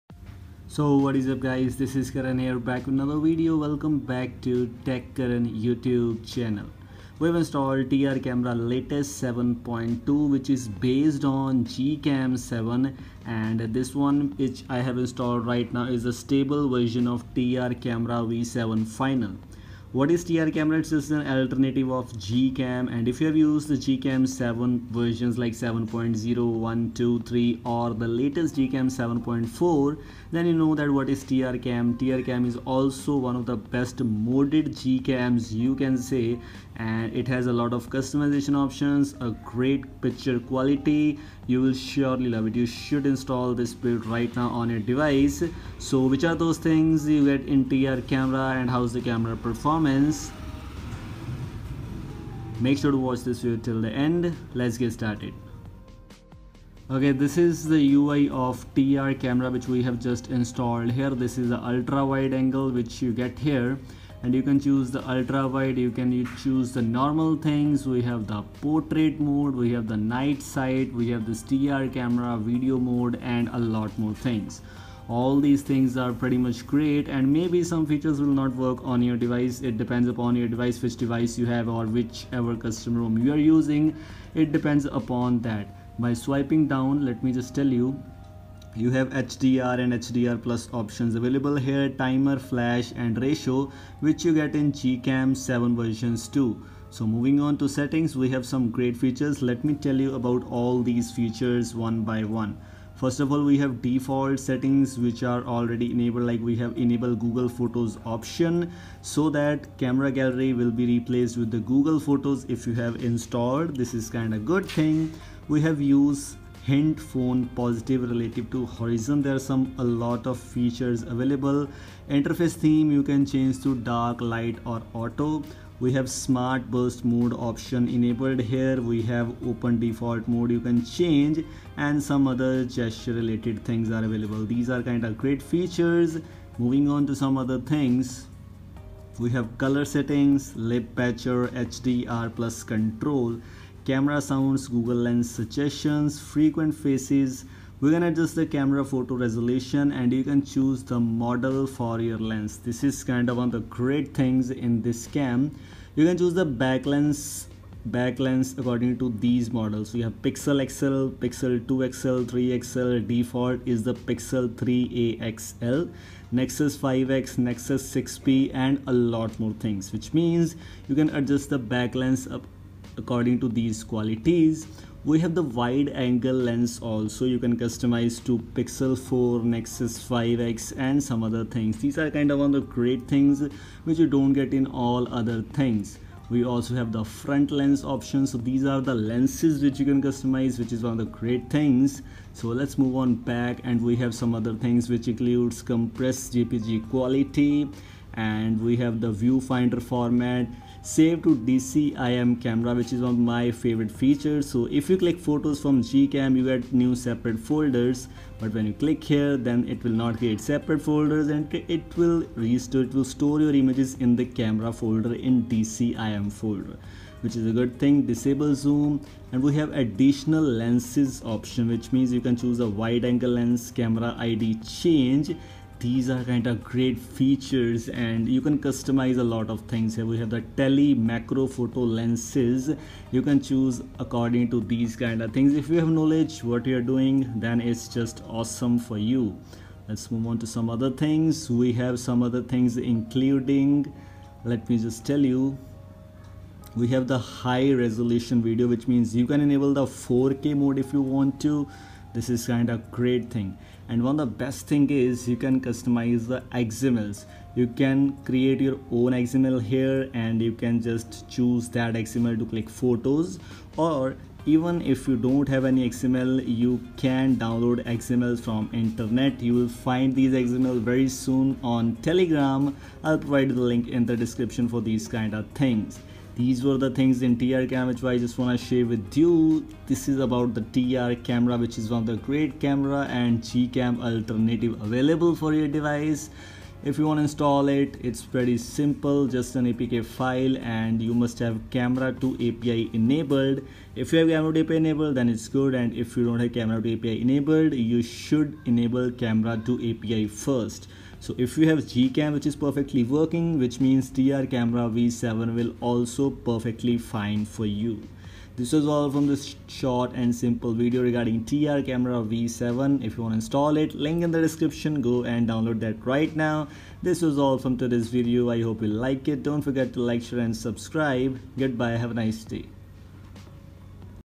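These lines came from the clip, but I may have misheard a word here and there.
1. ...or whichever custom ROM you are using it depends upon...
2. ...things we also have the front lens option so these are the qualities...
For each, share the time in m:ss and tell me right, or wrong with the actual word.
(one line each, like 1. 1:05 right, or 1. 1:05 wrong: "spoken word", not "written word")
1. 1:21 right
2. 3:05 wrong: "lenses", not "qualities".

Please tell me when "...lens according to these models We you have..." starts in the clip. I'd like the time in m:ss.
2:38.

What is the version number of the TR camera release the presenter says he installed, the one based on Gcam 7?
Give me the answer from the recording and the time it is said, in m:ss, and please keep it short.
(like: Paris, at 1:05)
7.2, at 0:09.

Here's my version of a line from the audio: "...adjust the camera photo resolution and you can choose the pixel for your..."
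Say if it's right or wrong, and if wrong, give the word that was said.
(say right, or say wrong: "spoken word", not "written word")
wrong: "model", not "pixel".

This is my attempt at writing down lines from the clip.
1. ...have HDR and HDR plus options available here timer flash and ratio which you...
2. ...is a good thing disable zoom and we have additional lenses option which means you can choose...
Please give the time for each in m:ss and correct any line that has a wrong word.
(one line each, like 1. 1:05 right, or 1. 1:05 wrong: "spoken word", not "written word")
1. 1:28 right
2. 3:37 right.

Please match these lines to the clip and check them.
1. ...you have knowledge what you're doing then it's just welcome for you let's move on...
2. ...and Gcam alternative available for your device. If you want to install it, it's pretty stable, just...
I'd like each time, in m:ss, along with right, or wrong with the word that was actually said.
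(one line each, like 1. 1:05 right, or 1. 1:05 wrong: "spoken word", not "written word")
1. 3:55 wrong: "awesome", not "welcome"
2. 4:43 wrong: "simple", not "stable".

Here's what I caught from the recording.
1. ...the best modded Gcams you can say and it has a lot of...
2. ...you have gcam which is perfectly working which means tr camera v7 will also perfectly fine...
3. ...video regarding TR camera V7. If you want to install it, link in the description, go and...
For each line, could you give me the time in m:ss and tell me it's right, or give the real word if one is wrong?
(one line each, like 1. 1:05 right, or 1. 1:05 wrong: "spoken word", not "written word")
1. 0:33 right
2. 5:01 right
3. 5:10 right.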